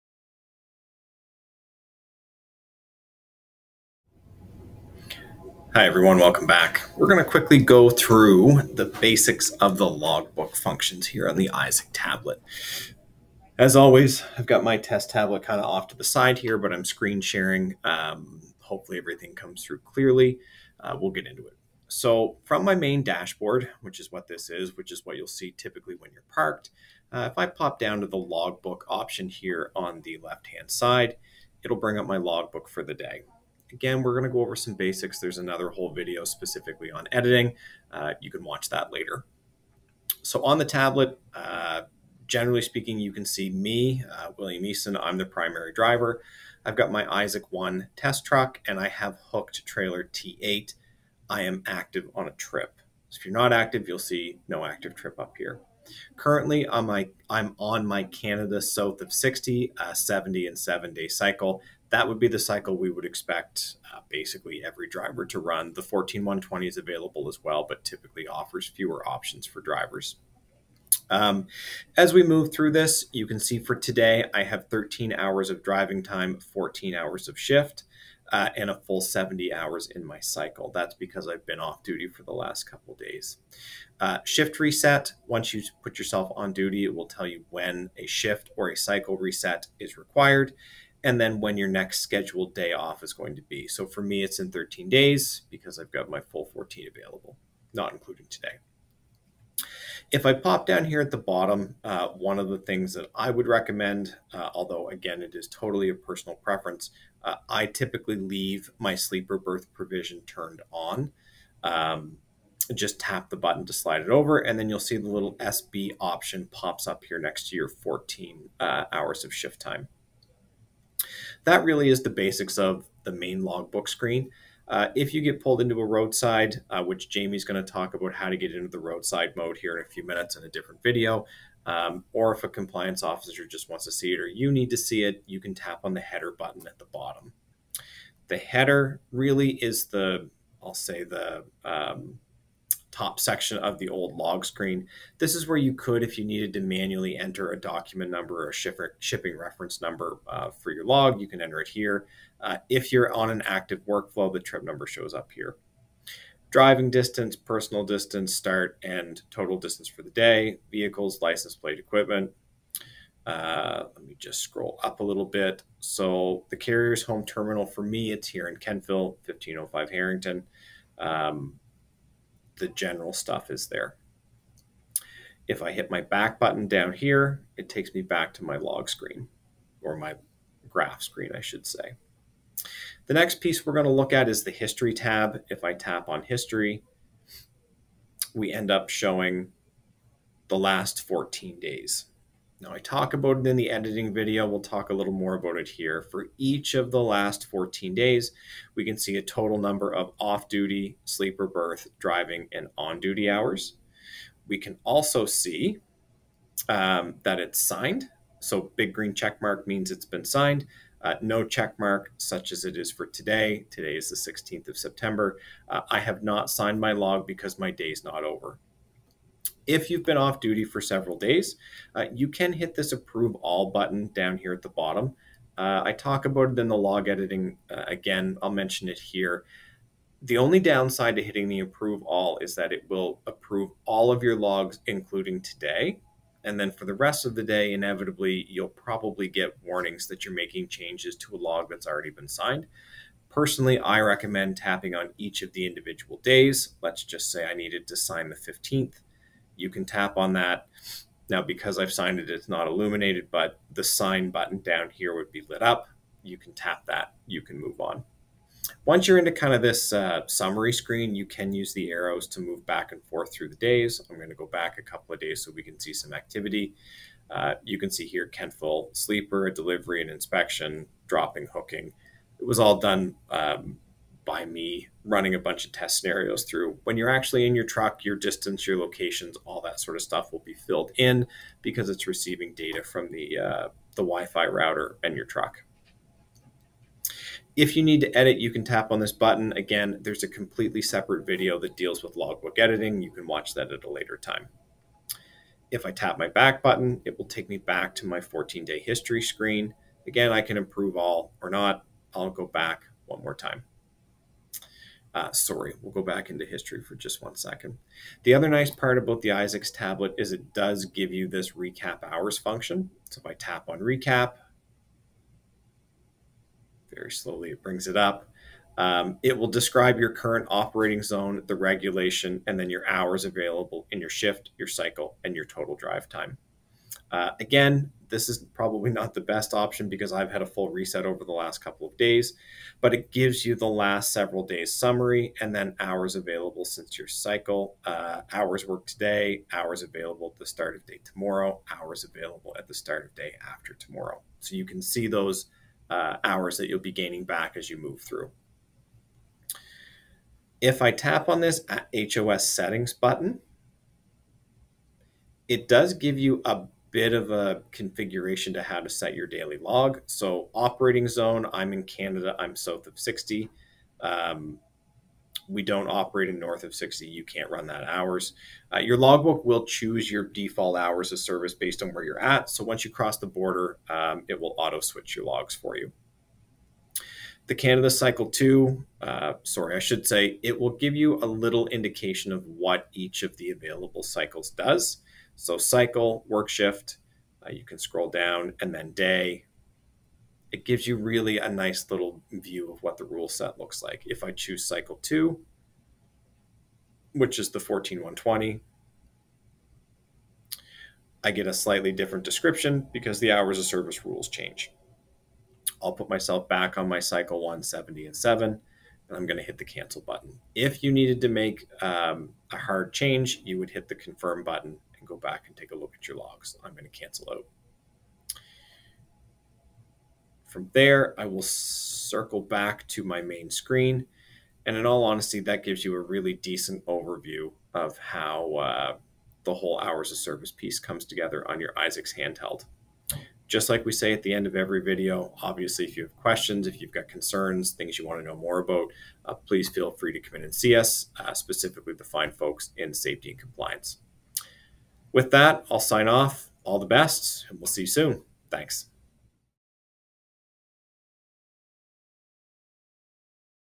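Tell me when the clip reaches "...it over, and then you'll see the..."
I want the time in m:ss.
1:54.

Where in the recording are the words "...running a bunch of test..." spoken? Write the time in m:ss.
4:35.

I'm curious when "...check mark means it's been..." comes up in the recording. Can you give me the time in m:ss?
3:29.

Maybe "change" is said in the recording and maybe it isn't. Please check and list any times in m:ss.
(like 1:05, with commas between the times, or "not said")
4:00, 6:44, 6:52.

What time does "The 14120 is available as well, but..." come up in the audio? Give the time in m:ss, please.
1:05.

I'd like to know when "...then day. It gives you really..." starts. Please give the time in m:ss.
6:28.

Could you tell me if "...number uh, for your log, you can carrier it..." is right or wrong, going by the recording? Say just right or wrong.
wrong.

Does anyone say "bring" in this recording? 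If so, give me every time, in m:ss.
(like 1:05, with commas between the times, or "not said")
0:31, 5:17.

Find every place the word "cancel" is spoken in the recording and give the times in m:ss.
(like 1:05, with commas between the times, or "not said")
6:49, 6:56.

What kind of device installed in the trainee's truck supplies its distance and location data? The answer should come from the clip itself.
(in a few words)
Wi-Fi router.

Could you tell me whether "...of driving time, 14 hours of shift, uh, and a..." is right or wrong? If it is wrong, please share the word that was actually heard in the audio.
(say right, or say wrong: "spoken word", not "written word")
right.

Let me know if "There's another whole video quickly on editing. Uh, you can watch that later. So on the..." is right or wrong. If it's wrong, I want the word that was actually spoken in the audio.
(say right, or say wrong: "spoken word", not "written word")
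wrong: "specifically", not "quickly".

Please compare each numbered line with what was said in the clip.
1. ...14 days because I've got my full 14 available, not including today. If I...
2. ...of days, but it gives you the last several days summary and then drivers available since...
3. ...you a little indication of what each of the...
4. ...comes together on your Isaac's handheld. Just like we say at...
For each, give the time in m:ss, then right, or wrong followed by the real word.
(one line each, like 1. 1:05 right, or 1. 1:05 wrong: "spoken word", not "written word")
1. 1:34 wrong: "13", not "14"
2. 5:31 wrong: "hours", not "drivers"
3. 6:20 right
4. 7:10 right.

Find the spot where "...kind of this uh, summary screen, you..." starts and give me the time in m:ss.
4:19.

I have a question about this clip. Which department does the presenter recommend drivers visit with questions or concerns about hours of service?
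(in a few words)
safety and compliance.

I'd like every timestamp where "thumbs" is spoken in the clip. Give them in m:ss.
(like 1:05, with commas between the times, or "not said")
not said.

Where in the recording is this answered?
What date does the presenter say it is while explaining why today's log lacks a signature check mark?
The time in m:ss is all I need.
3:34.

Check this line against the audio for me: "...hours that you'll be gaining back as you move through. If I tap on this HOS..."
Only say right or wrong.
right.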